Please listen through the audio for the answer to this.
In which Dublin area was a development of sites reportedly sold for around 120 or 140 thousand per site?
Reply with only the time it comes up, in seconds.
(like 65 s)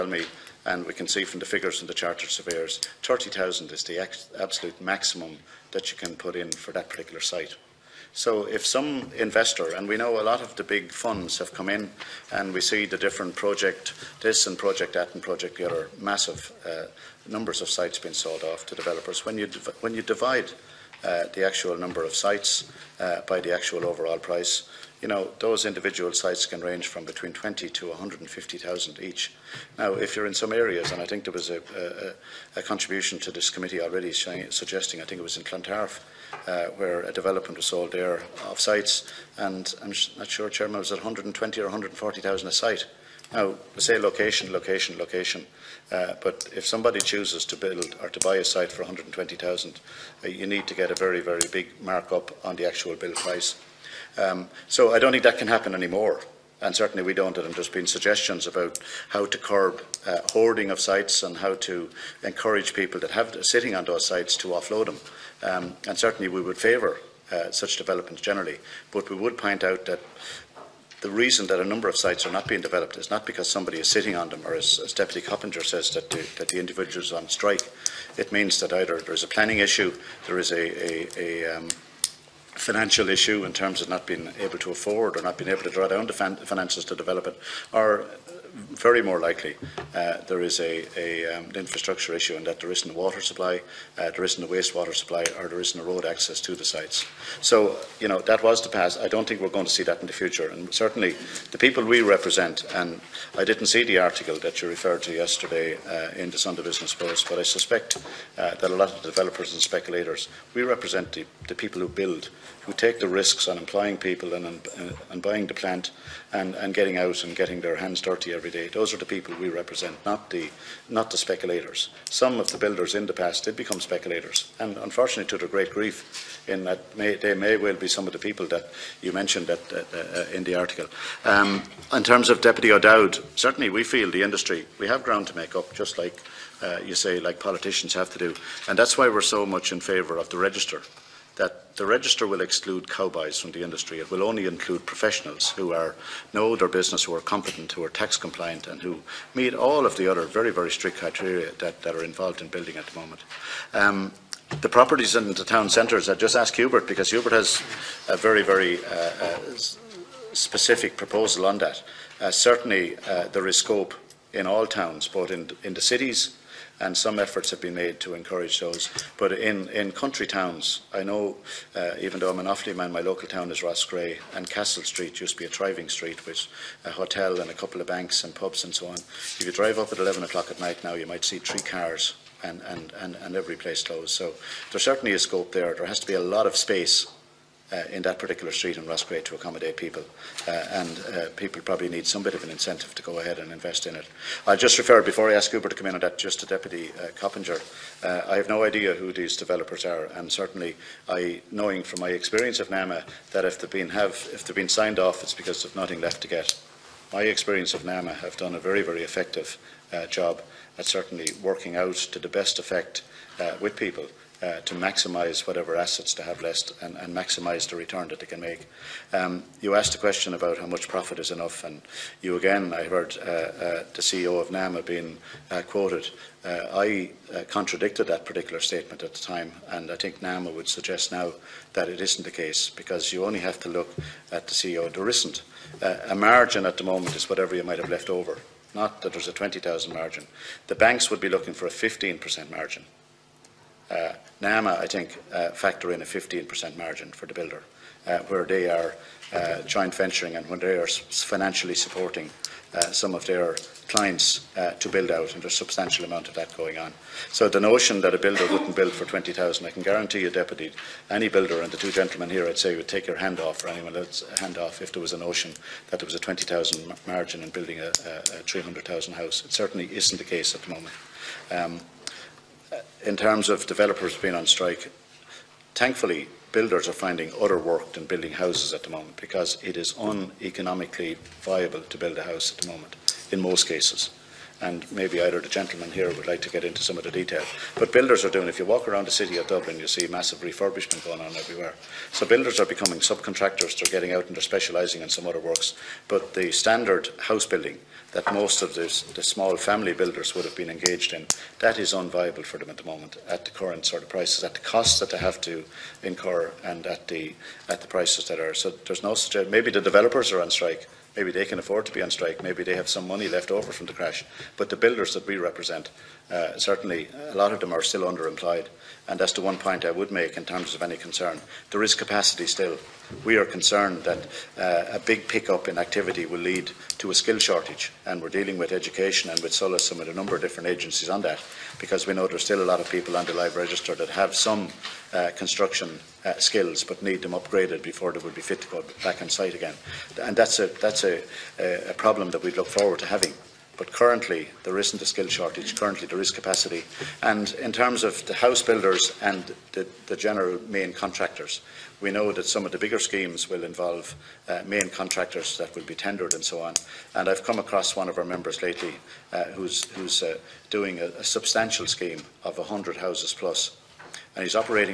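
35 s.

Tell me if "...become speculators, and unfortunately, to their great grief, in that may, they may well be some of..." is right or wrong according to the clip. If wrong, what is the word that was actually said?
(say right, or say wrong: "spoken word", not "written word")
right.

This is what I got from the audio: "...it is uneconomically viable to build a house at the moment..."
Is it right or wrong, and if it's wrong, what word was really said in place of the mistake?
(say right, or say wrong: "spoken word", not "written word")
right.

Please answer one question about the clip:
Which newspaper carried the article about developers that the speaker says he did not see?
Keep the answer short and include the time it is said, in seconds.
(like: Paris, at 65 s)
Sunday Business Post, at 106 s.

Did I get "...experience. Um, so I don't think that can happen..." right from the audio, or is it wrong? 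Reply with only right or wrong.
wrong.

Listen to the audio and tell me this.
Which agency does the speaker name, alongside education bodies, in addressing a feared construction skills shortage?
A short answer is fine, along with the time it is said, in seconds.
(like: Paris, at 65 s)
SOLAS, at 329 s.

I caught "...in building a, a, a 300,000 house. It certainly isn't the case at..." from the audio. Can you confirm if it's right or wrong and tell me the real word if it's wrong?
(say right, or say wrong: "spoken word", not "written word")
right.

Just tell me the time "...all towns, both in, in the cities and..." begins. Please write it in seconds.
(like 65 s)
164 s.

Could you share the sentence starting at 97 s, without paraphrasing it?
So, you know, that was the past.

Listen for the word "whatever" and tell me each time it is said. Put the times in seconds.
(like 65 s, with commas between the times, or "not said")
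215 s, 237 s.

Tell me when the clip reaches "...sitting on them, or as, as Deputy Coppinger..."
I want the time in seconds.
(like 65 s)
73 s.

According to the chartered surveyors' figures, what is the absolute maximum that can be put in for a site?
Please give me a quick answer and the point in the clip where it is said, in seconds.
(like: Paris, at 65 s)
30,000, at 3 s.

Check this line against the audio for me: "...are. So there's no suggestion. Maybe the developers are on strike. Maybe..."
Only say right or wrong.
right.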